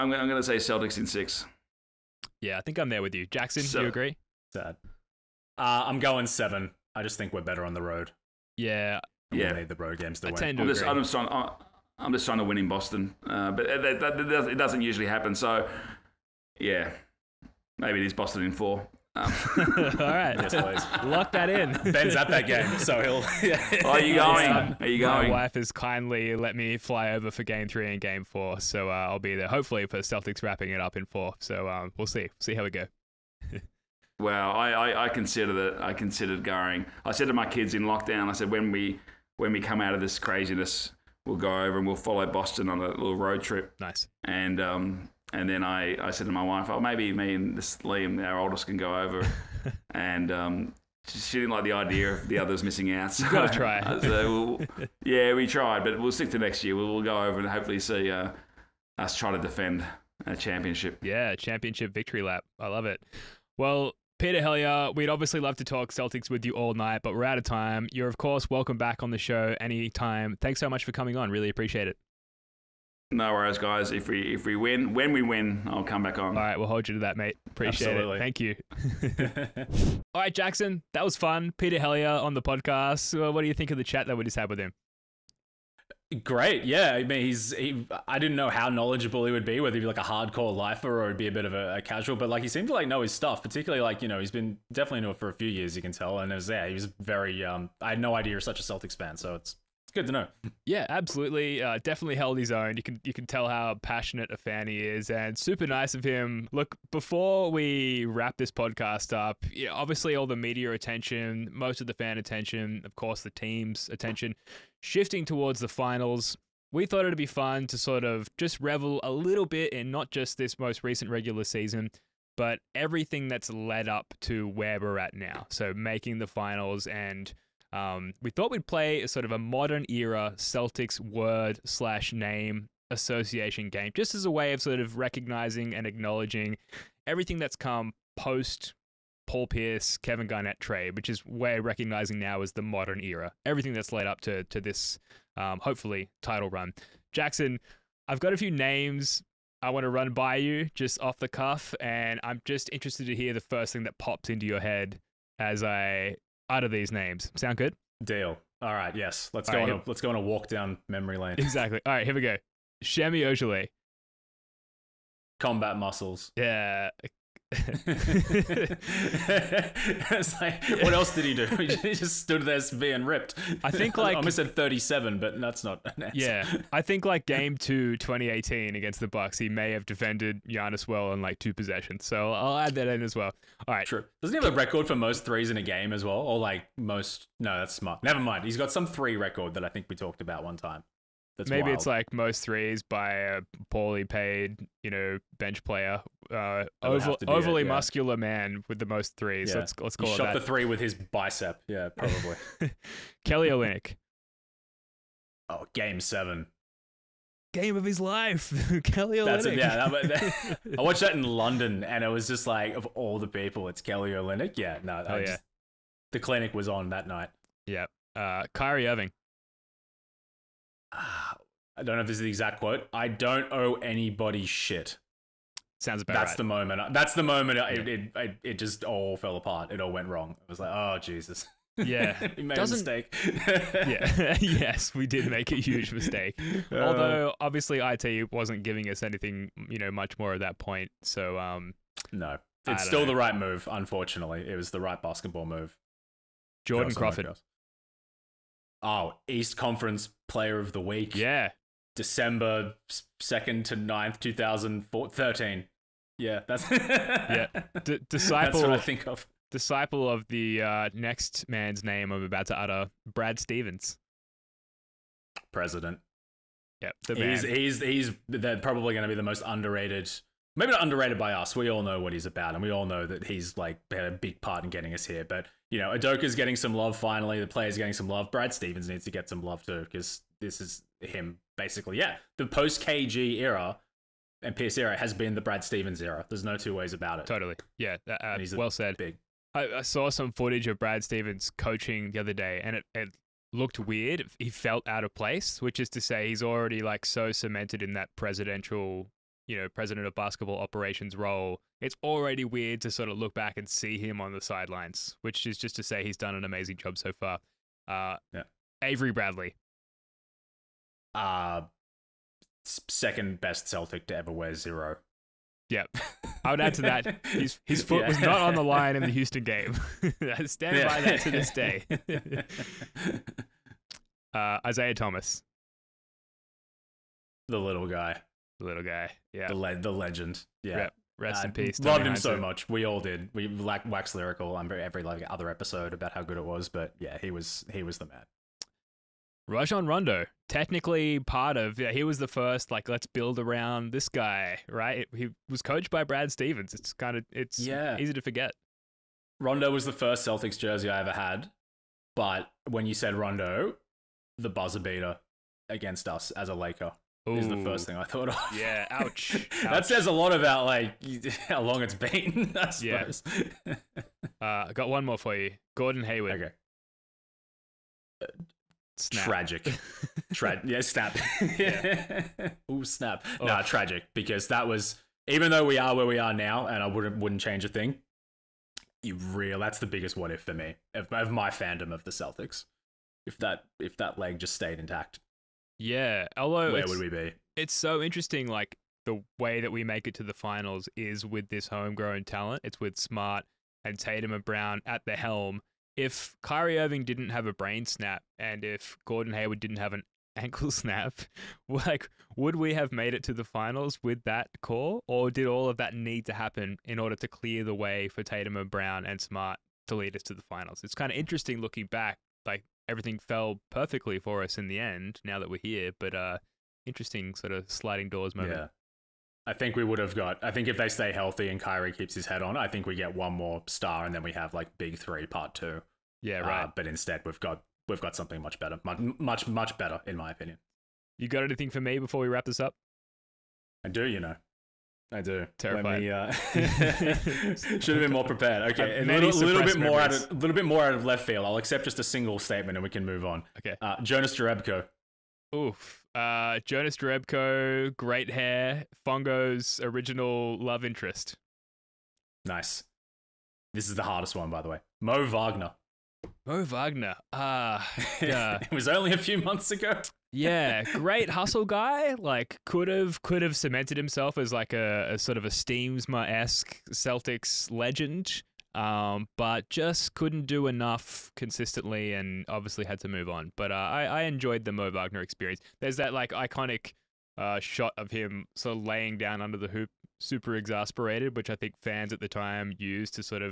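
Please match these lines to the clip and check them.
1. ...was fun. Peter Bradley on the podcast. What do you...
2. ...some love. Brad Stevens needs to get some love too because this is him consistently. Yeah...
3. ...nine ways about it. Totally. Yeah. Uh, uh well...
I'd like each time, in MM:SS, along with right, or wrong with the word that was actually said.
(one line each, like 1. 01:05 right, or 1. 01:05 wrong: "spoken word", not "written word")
1. 01:21 wrong: "Helliar", not "Bradley"
2. 04:37 wrong: "basically", not "consistently"
3. 04:46 wrong: "two", not "nine".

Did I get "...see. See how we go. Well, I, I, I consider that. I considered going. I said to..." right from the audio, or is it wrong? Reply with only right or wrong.
right.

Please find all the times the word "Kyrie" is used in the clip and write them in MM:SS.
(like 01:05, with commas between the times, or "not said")
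03:38, 06:36, 07:01.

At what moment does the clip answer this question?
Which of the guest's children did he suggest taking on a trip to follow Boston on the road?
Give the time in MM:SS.
00:47.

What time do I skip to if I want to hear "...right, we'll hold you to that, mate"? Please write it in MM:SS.
01:16.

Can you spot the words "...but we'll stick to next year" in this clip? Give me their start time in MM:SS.
00:55.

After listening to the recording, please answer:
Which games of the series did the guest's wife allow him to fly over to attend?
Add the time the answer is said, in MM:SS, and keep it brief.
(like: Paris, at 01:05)
Game 3 and Game 4, at 00:27.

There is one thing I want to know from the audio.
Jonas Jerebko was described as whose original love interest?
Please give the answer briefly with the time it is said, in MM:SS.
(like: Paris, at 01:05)
Fongo, at 07:29.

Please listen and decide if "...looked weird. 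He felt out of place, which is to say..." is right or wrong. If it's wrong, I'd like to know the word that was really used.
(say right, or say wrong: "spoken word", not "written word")
right.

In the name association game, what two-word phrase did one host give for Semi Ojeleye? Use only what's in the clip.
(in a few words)
Combat muscles.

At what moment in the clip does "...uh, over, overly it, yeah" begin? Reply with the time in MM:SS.
03:16.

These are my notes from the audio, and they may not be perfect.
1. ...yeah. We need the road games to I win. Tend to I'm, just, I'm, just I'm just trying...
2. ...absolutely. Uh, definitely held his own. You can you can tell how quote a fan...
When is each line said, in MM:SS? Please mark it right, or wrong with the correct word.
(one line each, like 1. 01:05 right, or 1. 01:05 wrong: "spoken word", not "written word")
1. 00:09 right
2. 01:40 wrong: "passionate", not "quote".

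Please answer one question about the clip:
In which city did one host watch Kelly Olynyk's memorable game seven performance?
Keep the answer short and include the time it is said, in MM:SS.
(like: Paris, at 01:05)
London, at 03:31.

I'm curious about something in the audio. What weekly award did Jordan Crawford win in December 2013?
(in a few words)
East Conference Player of the Week.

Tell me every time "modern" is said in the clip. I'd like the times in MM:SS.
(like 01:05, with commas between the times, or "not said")
02:09, 02:22.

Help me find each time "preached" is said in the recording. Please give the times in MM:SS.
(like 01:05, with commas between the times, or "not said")
not said.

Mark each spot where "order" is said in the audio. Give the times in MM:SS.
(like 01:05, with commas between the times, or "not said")
06:46.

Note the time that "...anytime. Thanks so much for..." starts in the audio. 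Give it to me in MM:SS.
01:09.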